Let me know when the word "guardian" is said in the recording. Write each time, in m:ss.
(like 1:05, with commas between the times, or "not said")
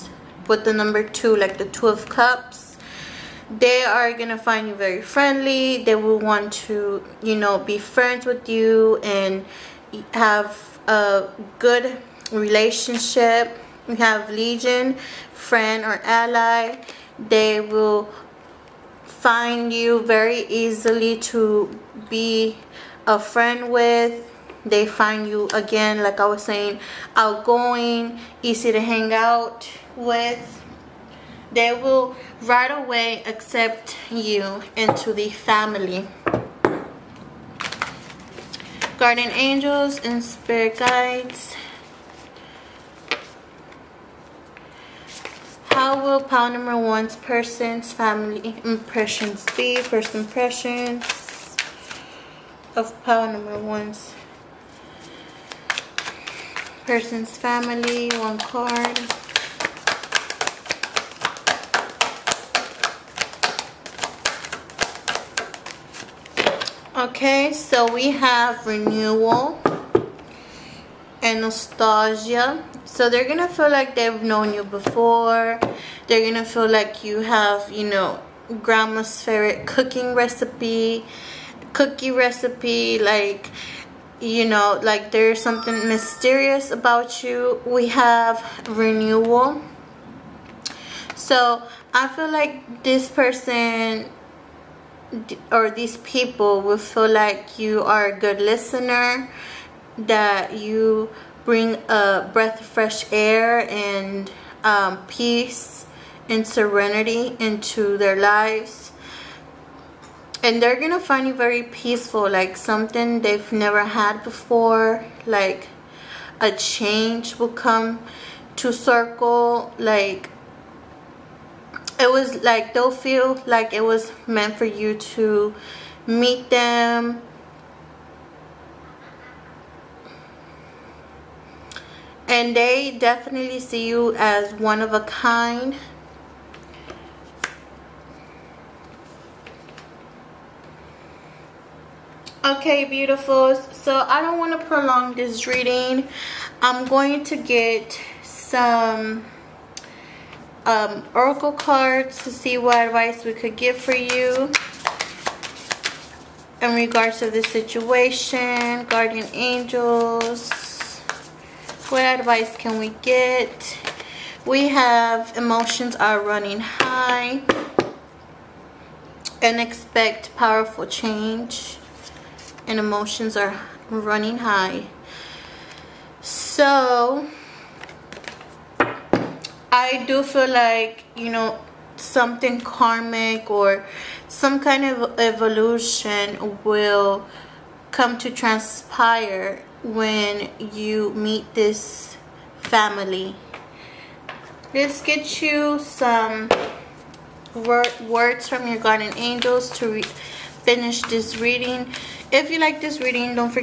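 0:38, 2:38, 3:18.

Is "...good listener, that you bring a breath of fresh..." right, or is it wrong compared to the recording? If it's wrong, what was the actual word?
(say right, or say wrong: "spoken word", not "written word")
right.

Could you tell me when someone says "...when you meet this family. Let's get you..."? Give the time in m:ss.
3:09.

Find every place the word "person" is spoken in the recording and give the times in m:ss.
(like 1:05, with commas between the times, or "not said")
0:47, 0:56, 1:33.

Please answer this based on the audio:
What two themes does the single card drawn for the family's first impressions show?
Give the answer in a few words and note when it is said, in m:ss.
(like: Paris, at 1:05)
Renewal and nostalgia, at 1:08.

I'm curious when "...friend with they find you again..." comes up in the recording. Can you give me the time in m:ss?
0:23.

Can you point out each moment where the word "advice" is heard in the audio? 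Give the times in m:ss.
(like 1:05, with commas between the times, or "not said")
2:32, 2:42.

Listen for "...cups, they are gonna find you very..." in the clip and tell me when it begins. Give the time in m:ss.
0:02.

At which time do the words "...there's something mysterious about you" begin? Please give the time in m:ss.
1:25.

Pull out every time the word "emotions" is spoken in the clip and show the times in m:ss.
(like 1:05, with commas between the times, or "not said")
2:45, 2:52.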